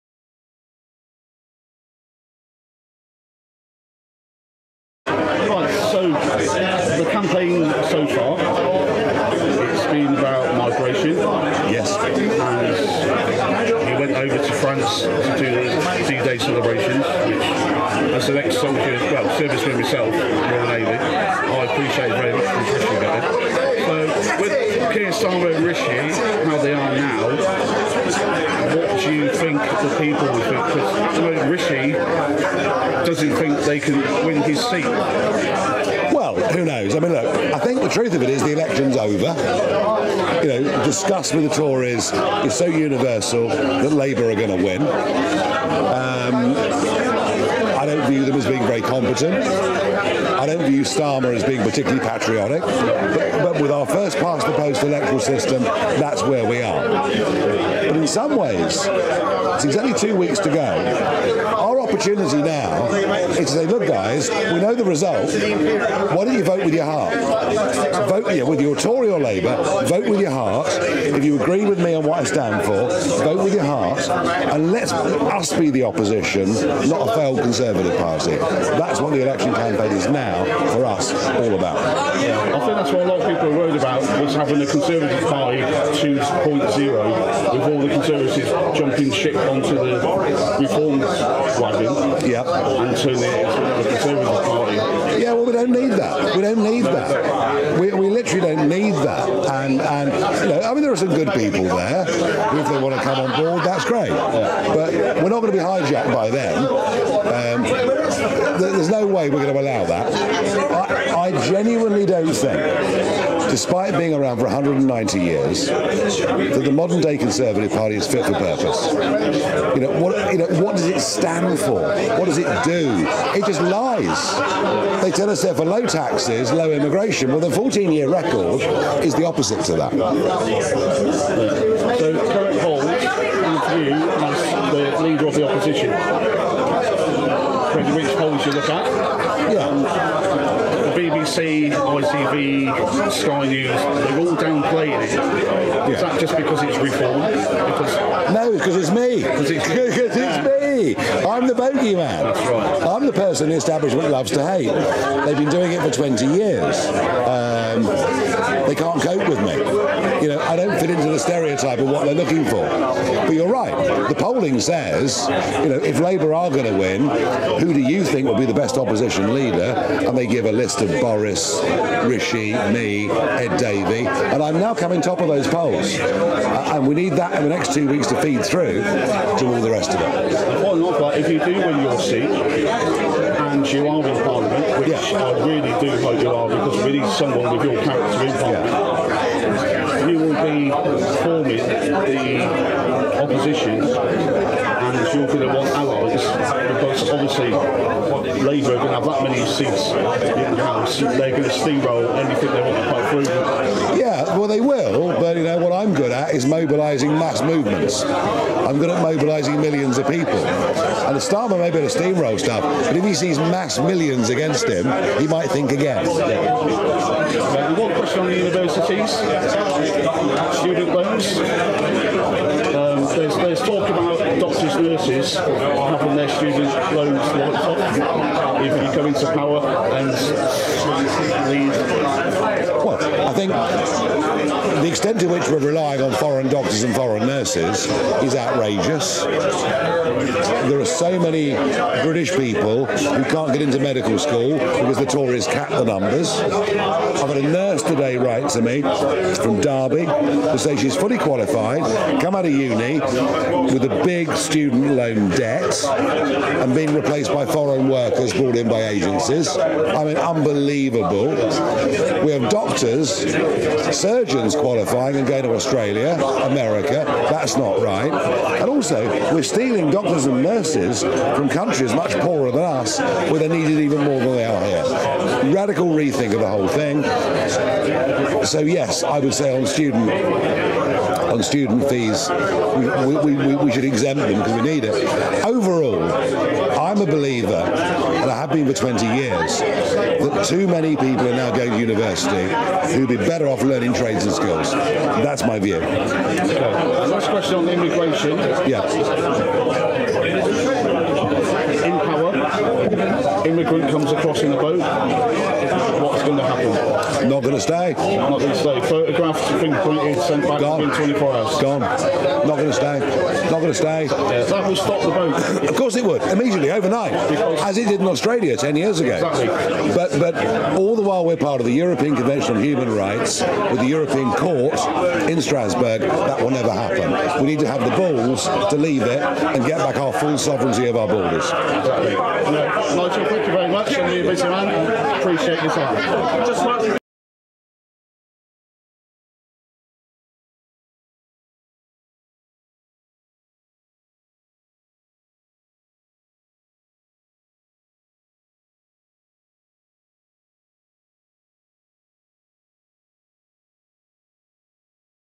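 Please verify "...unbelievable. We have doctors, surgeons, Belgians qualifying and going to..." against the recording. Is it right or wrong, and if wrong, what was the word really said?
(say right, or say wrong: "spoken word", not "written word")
right.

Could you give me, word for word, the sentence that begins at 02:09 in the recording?
So, current poll with you as the leader of the opposition.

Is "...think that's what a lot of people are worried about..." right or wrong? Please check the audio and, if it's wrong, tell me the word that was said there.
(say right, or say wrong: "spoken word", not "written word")
right.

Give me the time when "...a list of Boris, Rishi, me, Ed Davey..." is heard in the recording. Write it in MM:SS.
02:50.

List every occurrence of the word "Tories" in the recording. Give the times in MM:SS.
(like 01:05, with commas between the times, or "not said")
00:41, 04:05.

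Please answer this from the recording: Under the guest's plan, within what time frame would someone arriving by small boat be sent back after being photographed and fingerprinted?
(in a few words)
24 hours.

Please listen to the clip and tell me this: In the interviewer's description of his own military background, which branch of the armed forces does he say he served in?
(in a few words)
Royal Navy.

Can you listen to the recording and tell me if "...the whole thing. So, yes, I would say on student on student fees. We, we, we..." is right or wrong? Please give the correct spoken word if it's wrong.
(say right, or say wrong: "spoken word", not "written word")
right.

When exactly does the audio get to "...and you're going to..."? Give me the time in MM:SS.
03:13.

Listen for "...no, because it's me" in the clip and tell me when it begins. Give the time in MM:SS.
02:28.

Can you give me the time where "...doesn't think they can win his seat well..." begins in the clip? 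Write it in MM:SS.
00:31.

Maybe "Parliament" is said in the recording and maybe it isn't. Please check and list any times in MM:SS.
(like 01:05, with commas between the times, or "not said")
03:04, 03:08.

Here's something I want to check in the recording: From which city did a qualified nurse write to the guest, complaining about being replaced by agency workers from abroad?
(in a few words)
Derby.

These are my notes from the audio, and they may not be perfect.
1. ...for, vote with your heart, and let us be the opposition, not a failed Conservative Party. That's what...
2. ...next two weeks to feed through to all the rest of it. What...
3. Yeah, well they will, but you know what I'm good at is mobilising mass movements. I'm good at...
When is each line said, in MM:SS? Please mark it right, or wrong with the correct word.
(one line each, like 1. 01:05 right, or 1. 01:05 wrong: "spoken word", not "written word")
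1. 01:12 right
2. 02:57 right
3. 03:23 right.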